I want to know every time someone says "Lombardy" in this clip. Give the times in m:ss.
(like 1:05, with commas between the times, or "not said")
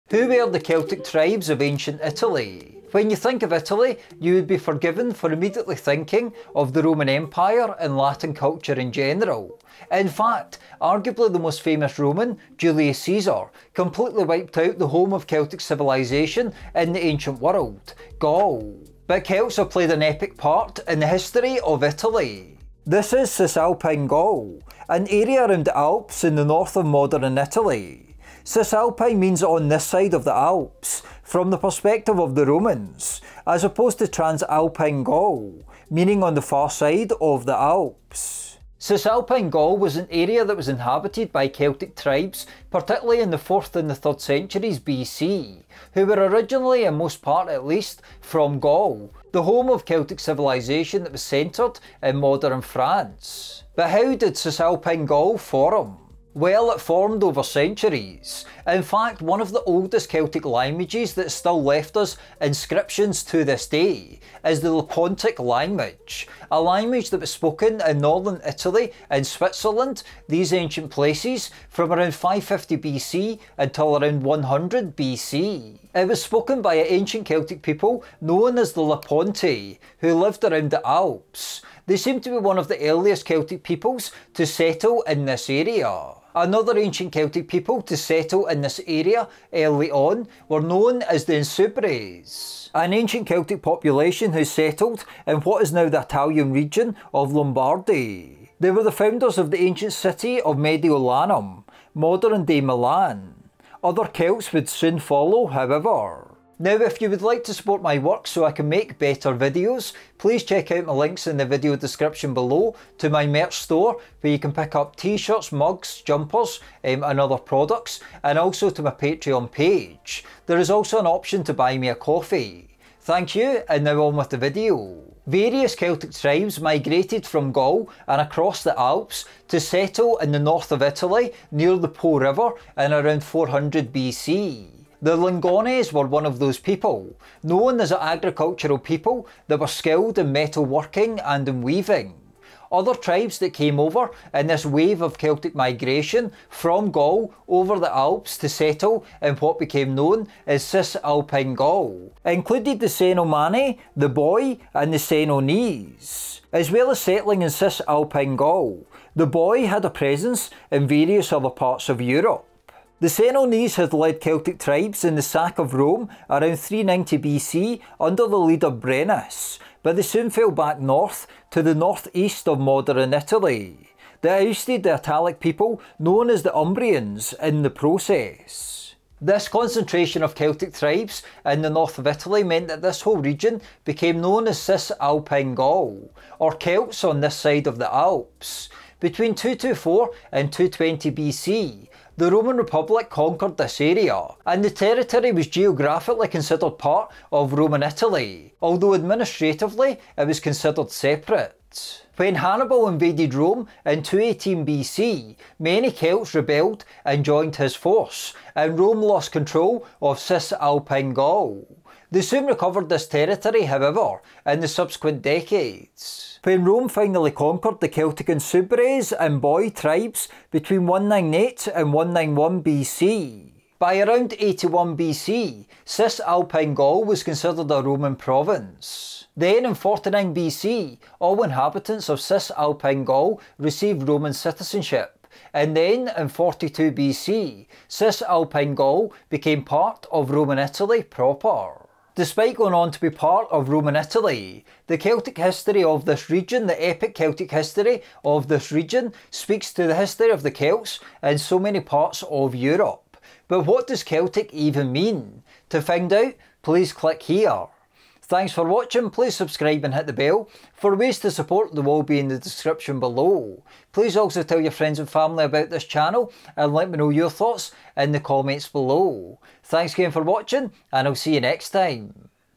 1:37.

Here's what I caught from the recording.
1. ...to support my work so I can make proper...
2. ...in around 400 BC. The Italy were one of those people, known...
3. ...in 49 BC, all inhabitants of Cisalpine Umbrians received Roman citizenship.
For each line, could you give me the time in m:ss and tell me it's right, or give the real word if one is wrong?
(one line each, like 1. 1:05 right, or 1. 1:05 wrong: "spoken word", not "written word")
1. 1:47 wrong: "better", not "proper"
2. 2:12 wrong: "Lingones", not "Italy"
3. 3:49 wrong: "Gaul", not "Umbrians".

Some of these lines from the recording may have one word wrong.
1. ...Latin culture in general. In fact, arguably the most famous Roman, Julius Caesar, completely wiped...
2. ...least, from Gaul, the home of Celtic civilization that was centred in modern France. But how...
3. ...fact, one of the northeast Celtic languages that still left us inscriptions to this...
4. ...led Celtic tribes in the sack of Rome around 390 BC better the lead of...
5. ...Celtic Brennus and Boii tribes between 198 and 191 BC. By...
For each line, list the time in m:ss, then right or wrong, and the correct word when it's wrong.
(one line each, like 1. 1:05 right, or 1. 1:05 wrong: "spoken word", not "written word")
1. 0:07 right
2. 0:47 right
3. 0:58 wrong: "oldest", not "northeast"
4. 2:43 wrong: "under", not "better"
5. 3:37 wrong: "Insubres", not "Brennus".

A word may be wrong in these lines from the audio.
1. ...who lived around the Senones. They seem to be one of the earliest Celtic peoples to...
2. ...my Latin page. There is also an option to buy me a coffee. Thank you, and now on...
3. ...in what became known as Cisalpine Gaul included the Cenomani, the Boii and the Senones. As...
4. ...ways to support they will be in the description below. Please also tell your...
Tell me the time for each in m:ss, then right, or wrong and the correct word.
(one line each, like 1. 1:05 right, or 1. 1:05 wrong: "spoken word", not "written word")
1. 1:19 wrong: "Alps", not "Senones"
2. 1:58 wrong: "Patreon", not "Latin"
3. 2:29 right
4. 4:20 right.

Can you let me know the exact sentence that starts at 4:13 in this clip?
But what does Celtic even mean?